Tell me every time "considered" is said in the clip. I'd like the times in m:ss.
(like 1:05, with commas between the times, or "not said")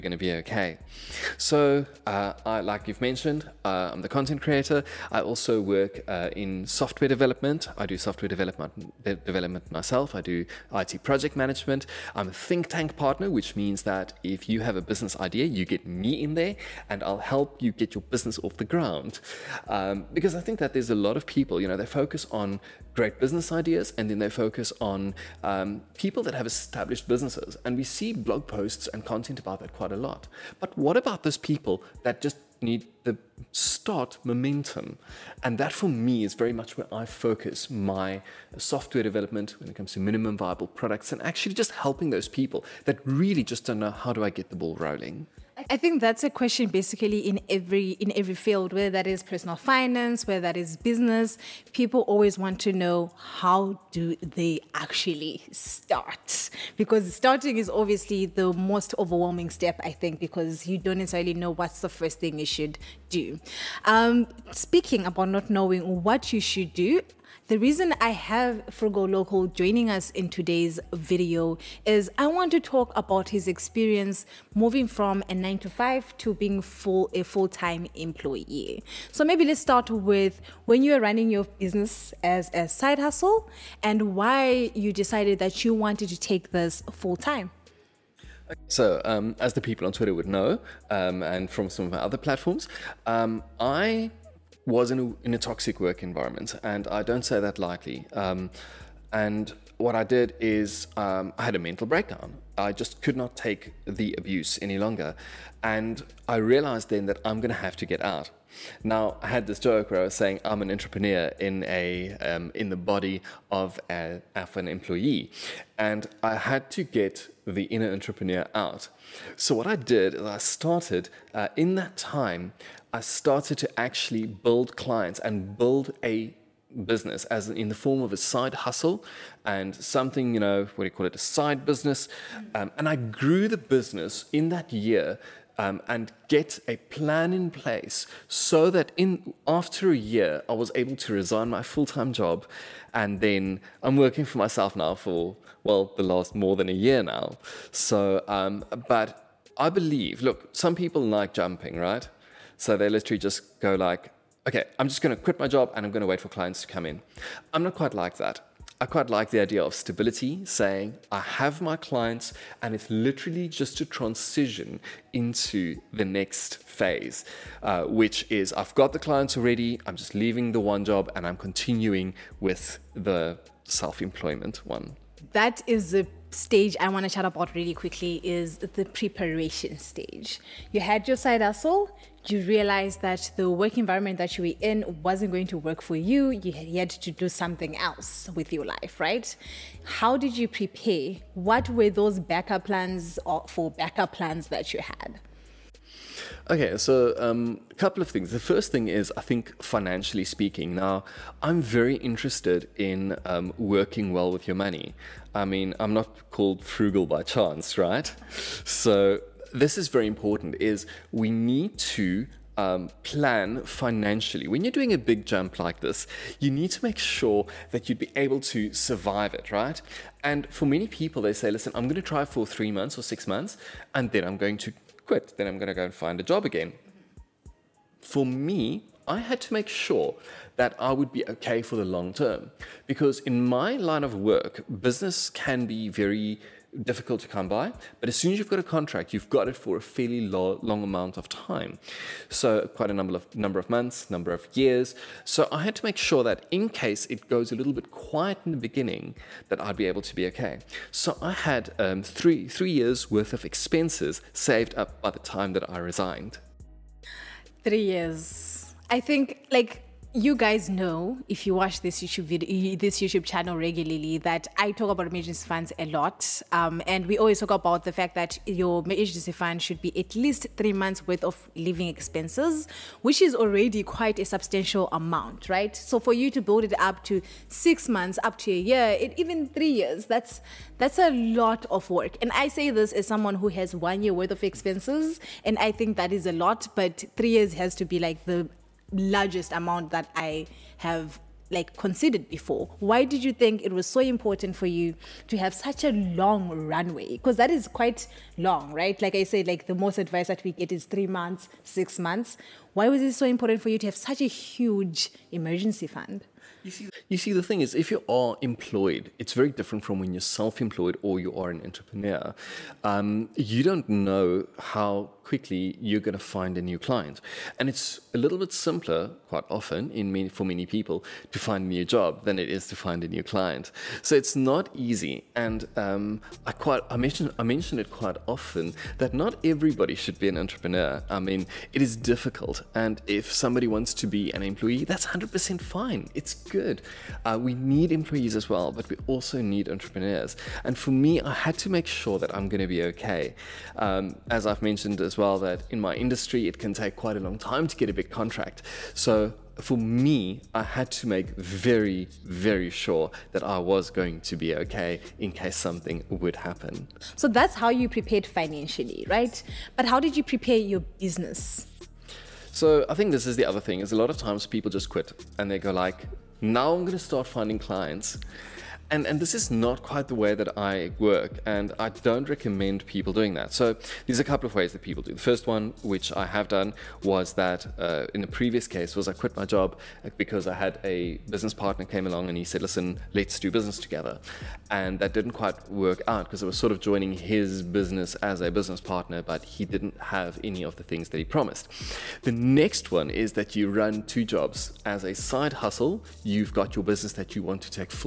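4:51.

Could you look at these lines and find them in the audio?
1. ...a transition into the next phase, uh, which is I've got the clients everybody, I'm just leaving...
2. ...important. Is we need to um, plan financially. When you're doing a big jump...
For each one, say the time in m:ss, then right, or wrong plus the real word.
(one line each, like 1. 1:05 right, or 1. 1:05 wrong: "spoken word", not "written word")
1. 2:43 wrong: "already", not "everybody"
2. 3:30 right.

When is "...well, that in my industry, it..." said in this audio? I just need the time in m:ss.
5:45.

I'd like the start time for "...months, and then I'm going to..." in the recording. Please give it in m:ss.
3:43.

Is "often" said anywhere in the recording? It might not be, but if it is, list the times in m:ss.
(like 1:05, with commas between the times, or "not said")
5:19, 5:28.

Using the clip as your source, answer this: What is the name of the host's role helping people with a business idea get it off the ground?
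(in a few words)
Think tank partner.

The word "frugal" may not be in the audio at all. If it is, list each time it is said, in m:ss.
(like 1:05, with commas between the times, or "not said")
1:08, 3:26.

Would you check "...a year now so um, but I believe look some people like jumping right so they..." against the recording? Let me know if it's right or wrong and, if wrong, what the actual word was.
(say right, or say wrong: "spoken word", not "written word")
right.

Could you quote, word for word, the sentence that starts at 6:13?
So there's a couple of ways that people do.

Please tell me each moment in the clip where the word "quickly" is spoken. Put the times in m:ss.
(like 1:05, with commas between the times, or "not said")
2:57, 5:15.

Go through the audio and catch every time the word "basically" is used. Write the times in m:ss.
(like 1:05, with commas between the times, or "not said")
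0:46.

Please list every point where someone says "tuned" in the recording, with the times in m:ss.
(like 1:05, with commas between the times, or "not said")
not said.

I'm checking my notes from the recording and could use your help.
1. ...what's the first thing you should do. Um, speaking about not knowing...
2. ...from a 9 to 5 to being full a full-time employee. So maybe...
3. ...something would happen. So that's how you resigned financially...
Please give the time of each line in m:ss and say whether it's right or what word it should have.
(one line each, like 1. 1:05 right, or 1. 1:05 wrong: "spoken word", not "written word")
1. 1:01 right
2. 1:14 right
3. 5:55 wrong: "prepared", not "resigned".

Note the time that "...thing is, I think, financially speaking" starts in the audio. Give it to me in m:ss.
3:18.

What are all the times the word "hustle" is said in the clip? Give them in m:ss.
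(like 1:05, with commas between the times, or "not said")
1:22, 2:08, 3:01, 6:35.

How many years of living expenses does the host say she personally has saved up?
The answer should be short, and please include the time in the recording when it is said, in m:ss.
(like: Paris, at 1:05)
1 year, at 4:43.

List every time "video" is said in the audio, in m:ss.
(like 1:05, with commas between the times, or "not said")
1:10, 4:22.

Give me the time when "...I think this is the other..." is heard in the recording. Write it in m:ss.
6:02.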